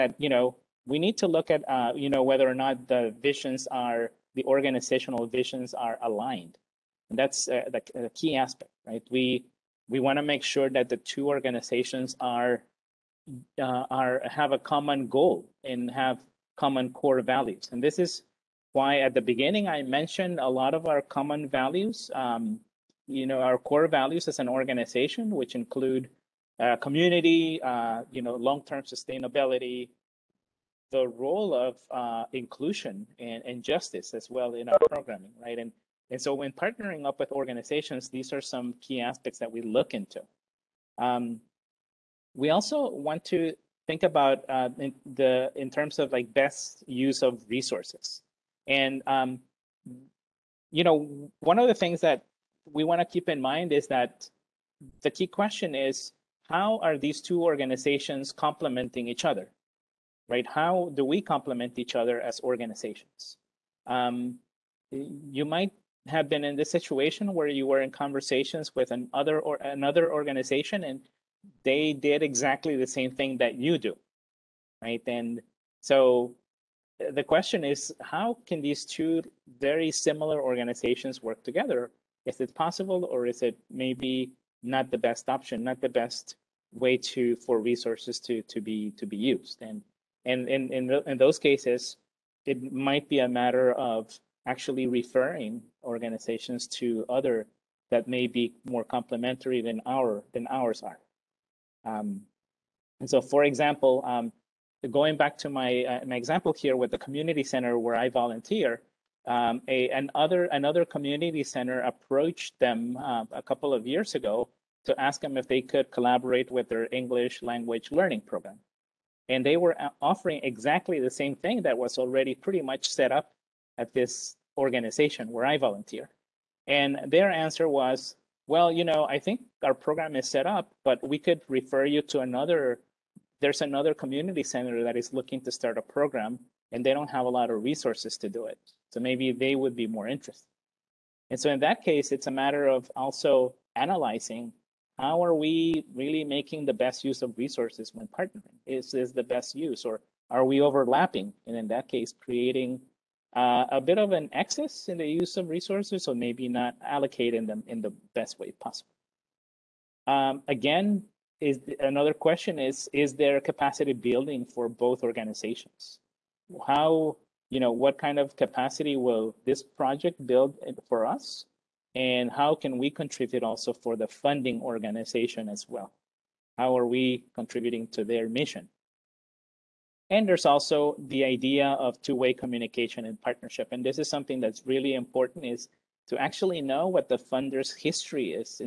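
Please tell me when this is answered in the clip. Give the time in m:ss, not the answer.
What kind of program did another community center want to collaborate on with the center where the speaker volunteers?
1:56.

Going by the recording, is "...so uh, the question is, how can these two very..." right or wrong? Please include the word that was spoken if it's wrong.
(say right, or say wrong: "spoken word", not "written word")
right.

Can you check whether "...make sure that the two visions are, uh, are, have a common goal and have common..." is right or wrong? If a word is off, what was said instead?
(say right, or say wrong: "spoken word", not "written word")
wrong: "organizations", not "visions".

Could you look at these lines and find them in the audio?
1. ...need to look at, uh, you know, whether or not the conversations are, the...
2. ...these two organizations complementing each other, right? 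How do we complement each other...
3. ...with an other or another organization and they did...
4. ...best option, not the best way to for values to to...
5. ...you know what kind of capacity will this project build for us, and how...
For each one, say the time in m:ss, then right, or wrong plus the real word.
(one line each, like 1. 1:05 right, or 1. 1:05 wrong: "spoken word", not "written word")
1. 0:00 wrong: "visions", not "conversations"
2. 0:56 right
3. 1:08 right
4. 1:24 wrong: "resources", not "values"
5. 2:47 right.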